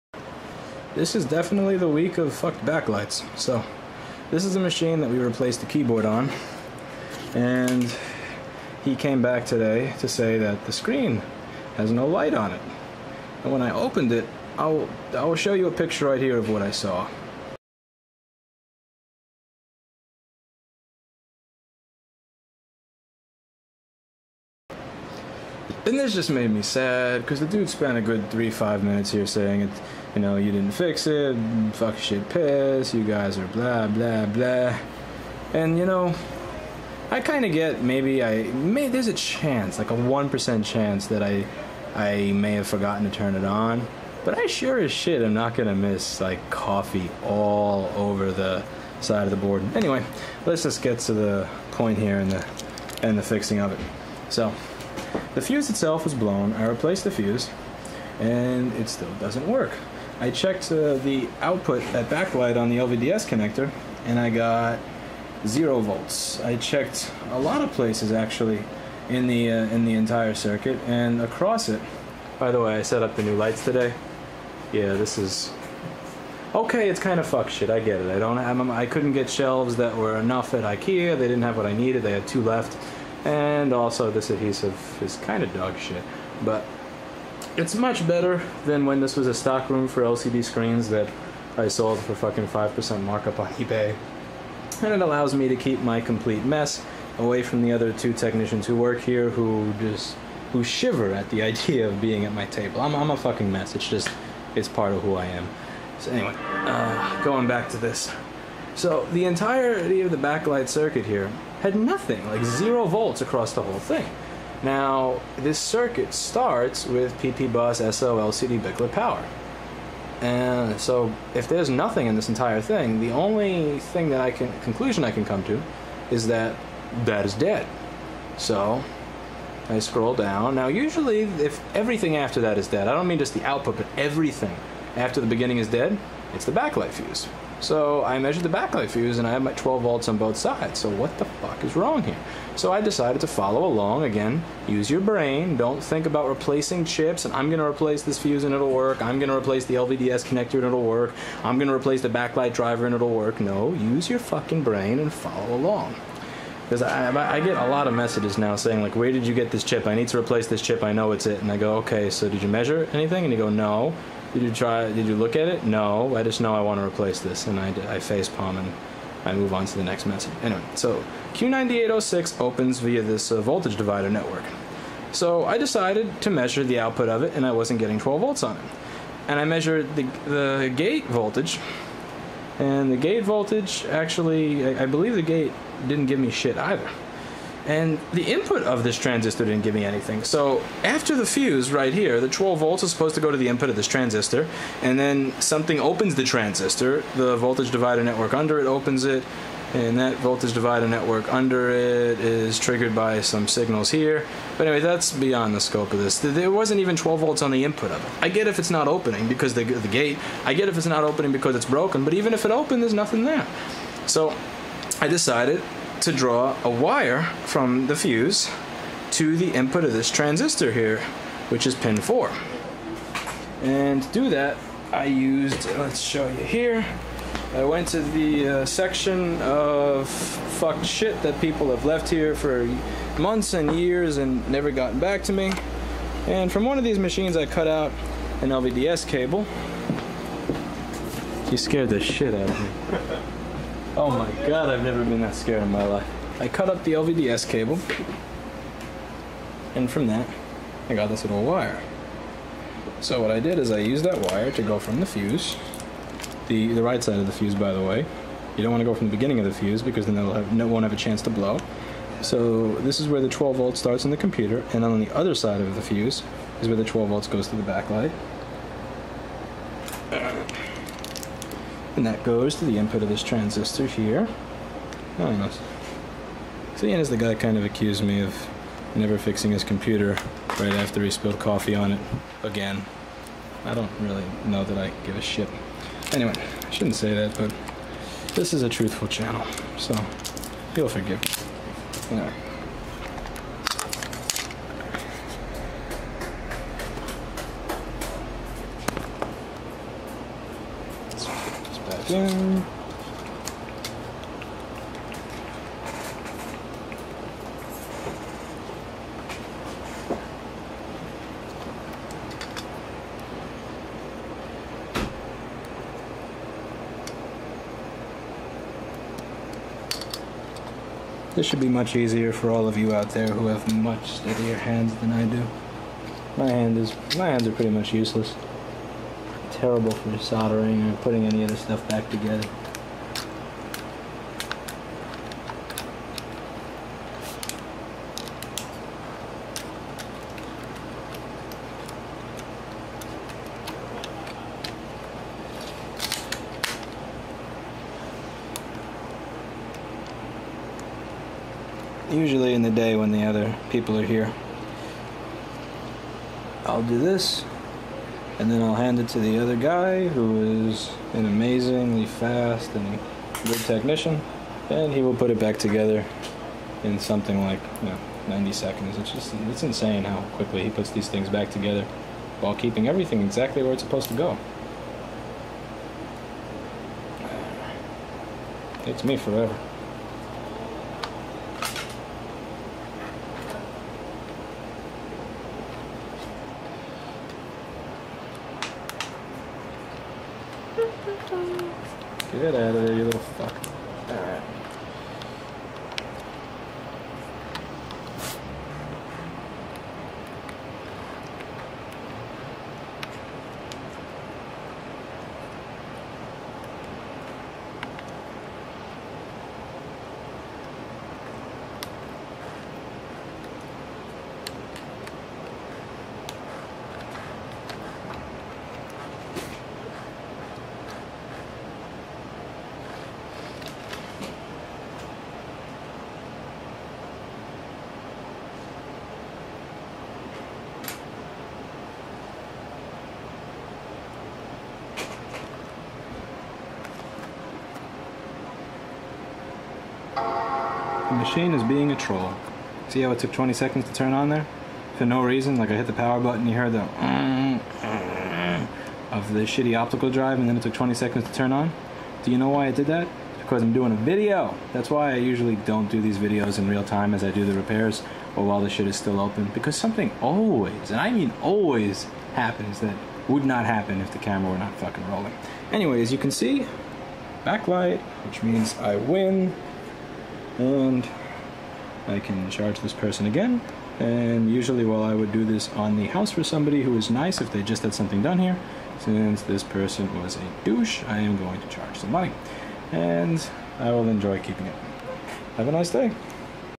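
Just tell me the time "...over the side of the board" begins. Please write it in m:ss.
0:47.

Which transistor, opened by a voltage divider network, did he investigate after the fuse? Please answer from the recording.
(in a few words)
Q9806.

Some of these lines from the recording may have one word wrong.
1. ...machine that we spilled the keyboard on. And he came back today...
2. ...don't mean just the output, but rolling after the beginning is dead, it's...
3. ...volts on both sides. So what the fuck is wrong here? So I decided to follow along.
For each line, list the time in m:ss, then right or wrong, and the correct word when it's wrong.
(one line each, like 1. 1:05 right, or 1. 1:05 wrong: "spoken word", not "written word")
1. 0:04 wrong: "replaced", not "spilled"
2. 2:12 wrong: "everything", not "rolling"
3. 2:19 right.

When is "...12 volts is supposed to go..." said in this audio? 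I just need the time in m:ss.
3:12.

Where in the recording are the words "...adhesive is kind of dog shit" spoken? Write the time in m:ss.
1:24.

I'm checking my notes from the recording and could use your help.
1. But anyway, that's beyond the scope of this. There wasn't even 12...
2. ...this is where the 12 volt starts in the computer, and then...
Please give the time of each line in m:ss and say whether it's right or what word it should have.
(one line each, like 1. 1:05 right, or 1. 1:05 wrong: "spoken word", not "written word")
1. 3:24 right
2. 4:22 right.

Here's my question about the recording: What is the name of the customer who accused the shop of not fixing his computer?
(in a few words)
Ian.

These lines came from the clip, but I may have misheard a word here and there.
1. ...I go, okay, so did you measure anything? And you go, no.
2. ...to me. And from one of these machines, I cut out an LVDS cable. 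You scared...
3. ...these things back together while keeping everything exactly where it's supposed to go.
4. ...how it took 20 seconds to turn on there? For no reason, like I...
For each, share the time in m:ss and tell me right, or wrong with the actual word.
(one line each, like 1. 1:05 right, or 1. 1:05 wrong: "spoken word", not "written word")
1. 2:41 right
2. 3:55 right
3. 6:10 right
4. 7:23 right.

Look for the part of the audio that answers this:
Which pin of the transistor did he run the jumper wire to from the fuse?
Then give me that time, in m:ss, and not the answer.
3:41.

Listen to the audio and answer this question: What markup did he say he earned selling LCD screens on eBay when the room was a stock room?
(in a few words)
5%.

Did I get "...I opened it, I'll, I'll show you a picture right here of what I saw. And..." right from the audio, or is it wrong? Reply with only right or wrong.
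right.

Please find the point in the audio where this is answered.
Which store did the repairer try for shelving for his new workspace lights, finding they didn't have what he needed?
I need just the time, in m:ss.
1:20.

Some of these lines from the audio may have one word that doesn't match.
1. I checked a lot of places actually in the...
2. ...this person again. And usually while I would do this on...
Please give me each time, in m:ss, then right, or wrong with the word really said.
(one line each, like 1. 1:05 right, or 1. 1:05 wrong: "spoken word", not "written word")
1. 1:06 right
2. 7:52 right.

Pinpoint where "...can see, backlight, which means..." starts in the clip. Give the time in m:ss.
7:46.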